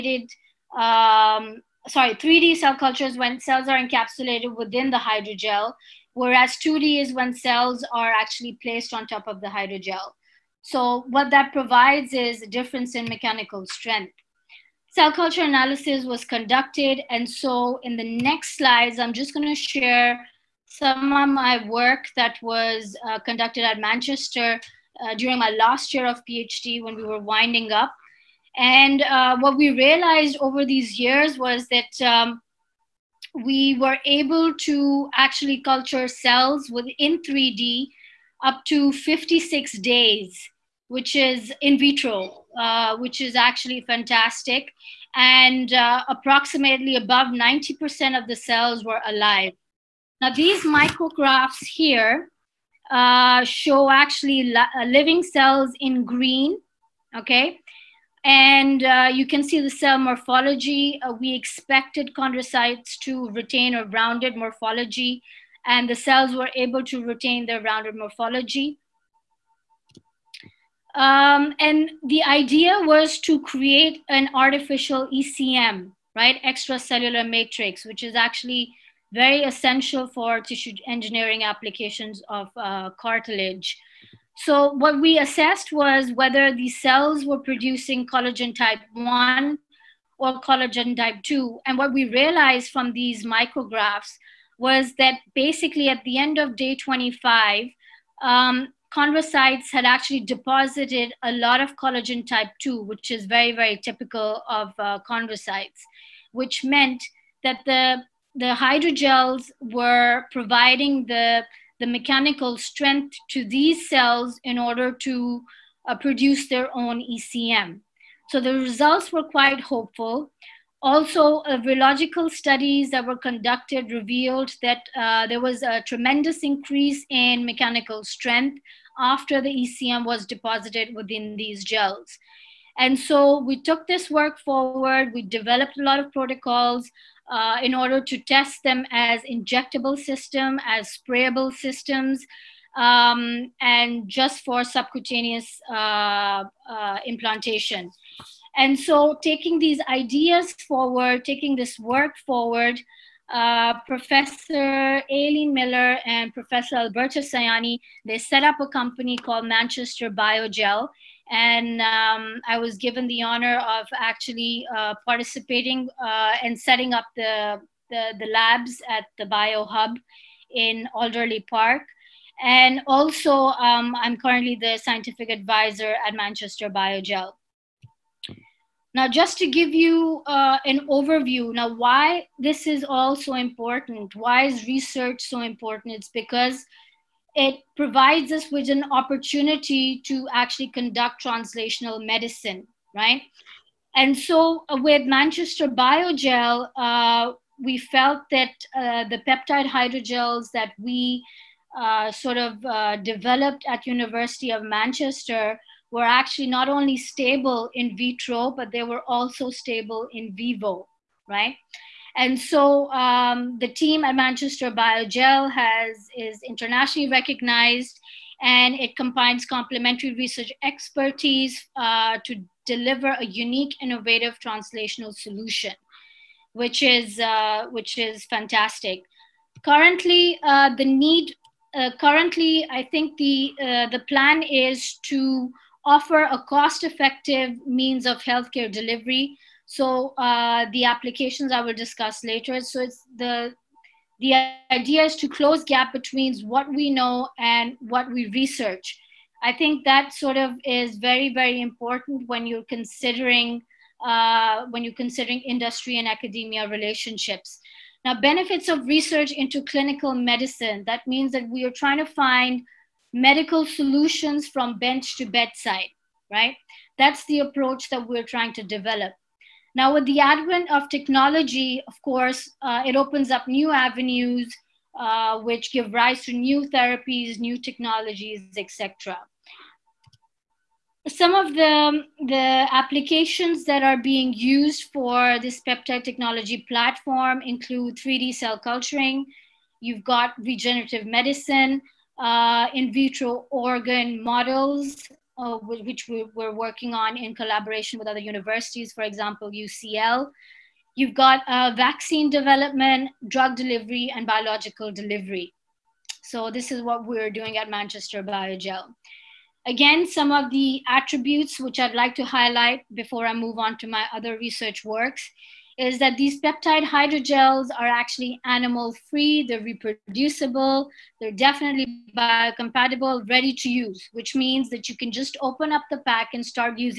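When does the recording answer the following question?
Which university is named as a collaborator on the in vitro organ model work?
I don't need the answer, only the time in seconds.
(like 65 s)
299 s.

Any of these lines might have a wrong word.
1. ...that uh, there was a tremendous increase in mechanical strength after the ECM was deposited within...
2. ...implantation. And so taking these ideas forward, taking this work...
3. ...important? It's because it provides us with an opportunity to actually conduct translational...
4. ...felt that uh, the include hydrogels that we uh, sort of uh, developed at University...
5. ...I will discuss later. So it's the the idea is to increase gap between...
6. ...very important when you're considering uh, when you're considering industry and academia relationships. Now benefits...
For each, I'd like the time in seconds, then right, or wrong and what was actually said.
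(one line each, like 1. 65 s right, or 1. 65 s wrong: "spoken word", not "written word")
1. 124 s right
2. 147 s right
3. 185 s right
4. 197 s wrong: "peptide", not "include"
5. 241 s wrong: "close", not "increase"
6. 251 s right.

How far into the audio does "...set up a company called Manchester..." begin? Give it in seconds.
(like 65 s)
158 s.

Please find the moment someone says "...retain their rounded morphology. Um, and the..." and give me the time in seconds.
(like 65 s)
67 s.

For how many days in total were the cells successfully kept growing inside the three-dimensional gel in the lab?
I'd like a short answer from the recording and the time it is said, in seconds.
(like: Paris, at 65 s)
56 days, at 38 s.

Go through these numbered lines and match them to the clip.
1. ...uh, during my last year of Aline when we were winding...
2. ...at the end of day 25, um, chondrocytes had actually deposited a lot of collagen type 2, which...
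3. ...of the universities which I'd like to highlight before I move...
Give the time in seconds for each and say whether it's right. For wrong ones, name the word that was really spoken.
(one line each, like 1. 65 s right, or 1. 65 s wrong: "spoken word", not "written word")
1. 25 s wrong: "PhD", not "Aline"
2. 95 s right
3. 310 s wrong: "attributes", not "universities".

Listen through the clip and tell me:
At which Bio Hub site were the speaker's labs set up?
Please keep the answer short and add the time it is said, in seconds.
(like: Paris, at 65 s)
Alderley Park, at 170 s.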